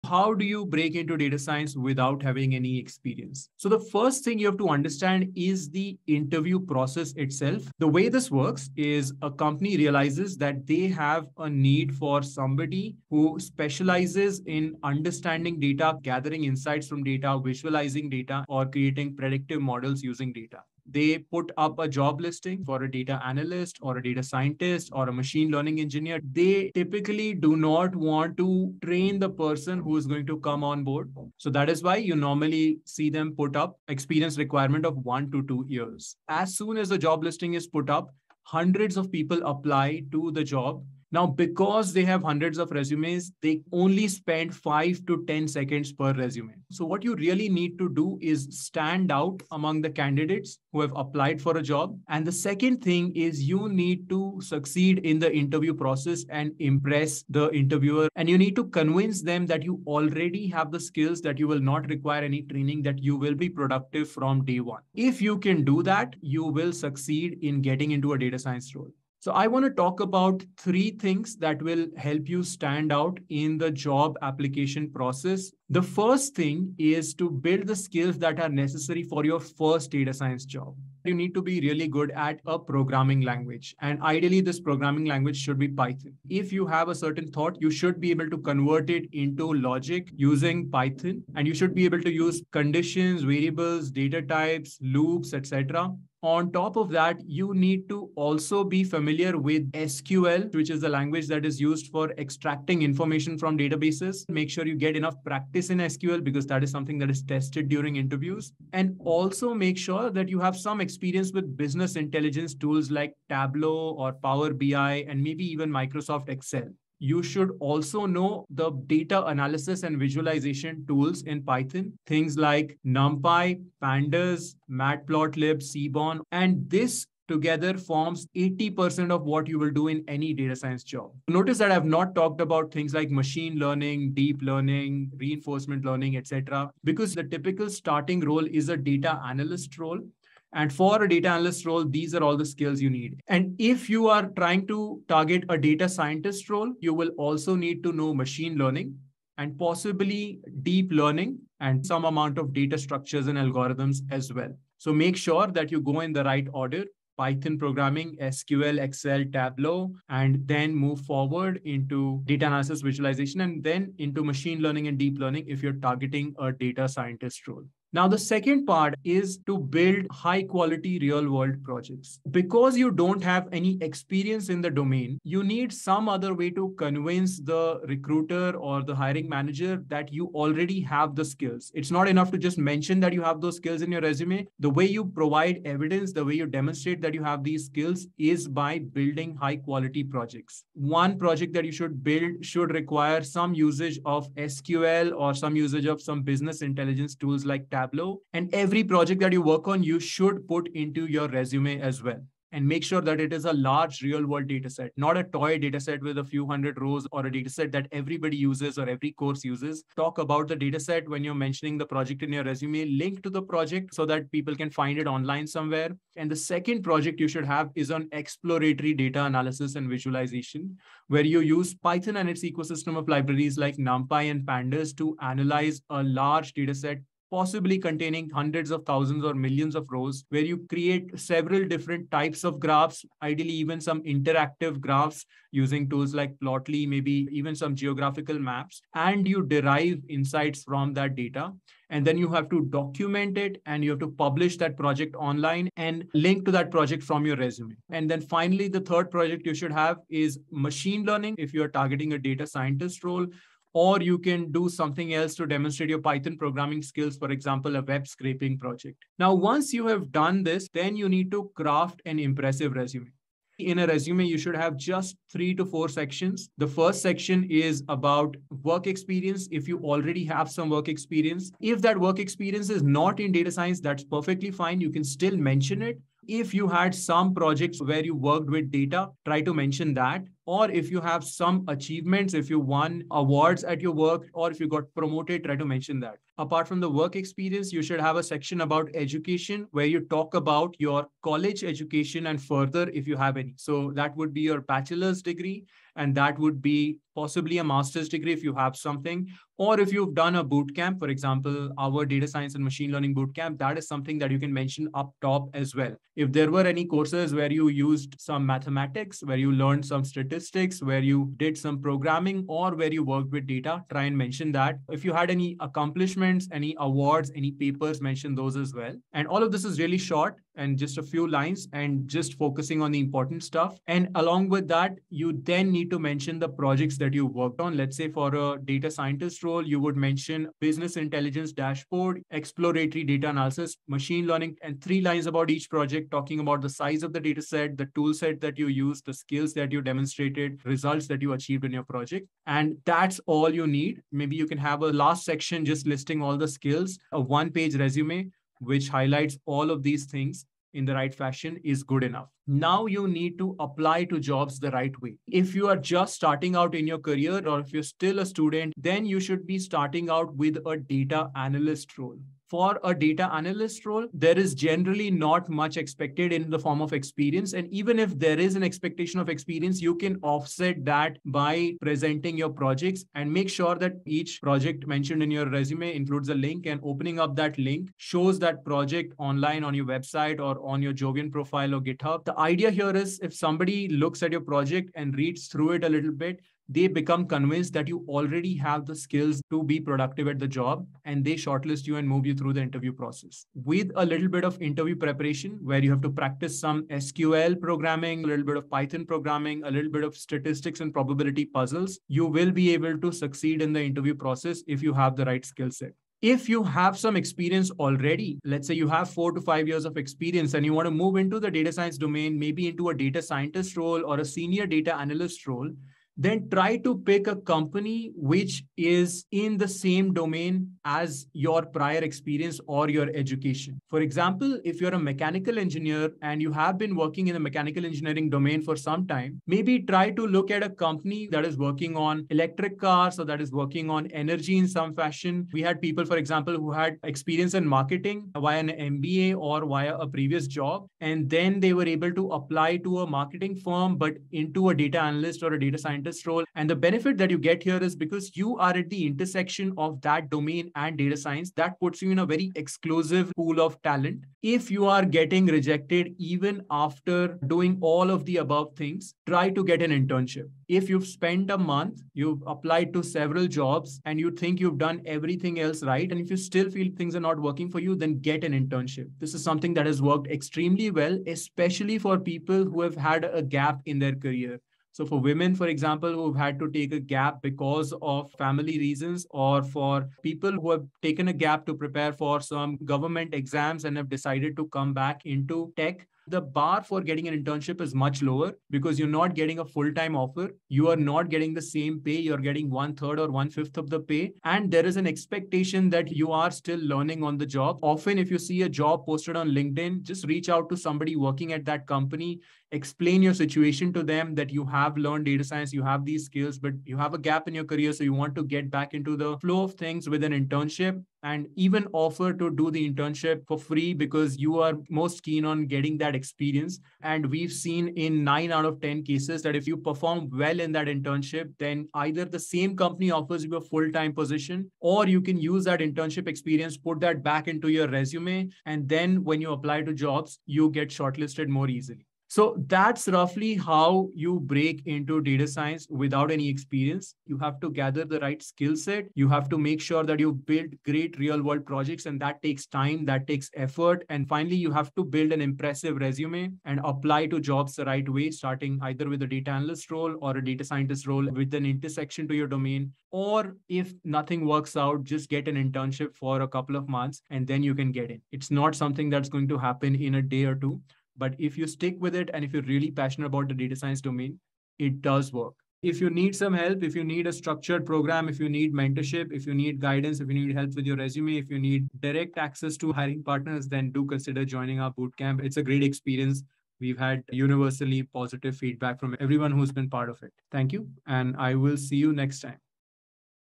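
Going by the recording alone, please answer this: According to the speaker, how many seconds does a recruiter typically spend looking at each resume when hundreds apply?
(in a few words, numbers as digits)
5 to 10 seconds.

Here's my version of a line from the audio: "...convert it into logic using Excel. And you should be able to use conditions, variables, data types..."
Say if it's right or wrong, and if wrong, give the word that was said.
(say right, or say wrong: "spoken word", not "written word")
wrong: "Python", not "Excel".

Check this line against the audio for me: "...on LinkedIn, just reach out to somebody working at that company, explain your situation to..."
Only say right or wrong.
right.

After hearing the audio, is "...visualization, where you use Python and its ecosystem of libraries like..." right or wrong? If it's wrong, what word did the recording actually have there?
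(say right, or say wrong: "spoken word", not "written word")
right.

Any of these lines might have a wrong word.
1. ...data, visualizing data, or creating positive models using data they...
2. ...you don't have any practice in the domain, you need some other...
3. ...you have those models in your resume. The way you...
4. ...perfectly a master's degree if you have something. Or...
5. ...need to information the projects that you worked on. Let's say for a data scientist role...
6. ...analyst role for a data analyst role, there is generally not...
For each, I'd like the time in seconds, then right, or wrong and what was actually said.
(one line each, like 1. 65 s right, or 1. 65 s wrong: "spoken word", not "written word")
1. 17 s wrong: "predictive", not "positive"
2. 172 s wrong: "experience", not "practice"
3. 183 s wrong: "skills", not "models"
4. 297 s wrong: "possibly", not "perfectly"
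5. 325 s wrong: "mention", not "information"
6. 361 s right.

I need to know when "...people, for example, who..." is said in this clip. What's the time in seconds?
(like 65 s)
435 s.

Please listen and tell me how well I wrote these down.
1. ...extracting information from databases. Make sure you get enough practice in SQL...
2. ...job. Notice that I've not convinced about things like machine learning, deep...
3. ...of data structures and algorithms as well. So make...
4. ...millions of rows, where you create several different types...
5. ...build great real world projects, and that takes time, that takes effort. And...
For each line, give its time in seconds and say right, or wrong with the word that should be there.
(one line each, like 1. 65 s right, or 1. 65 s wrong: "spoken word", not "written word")
1. 102 s right
2. 130 s wrong: "talked", not "convinced"
3. 152 s right
4. 229 s right
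5. 540 s right.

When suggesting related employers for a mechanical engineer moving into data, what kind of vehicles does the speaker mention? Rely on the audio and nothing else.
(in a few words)
Electric cars.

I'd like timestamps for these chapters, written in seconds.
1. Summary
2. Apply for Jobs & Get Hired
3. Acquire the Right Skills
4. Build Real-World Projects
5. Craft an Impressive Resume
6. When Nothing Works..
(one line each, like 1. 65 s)
1. 532 s
2. 352 s
3. 75 s
4. 167 s
5. 259 s
6. 454 s.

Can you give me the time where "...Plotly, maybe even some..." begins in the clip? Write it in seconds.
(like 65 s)
236 s.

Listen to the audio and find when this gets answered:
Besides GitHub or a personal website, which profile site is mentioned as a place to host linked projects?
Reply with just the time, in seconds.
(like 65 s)
380 s.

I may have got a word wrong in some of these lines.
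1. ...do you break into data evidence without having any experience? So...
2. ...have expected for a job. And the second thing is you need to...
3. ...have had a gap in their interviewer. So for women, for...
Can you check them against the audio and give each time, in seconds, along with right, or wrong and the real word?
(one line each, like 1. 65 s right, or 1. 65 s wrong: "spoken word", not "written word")
1. 0 s wrong: "science", not "evidence"
2. 50 s wrong: "applied", not "expected"
3. 472 s wrong: "career", not "interviewer".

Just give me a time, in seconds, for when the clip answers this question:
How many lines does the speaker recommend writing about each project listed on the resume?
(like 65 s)
334 s.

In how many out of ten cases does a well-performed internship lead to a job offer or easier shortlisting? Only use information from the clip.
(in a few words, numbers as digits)
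9.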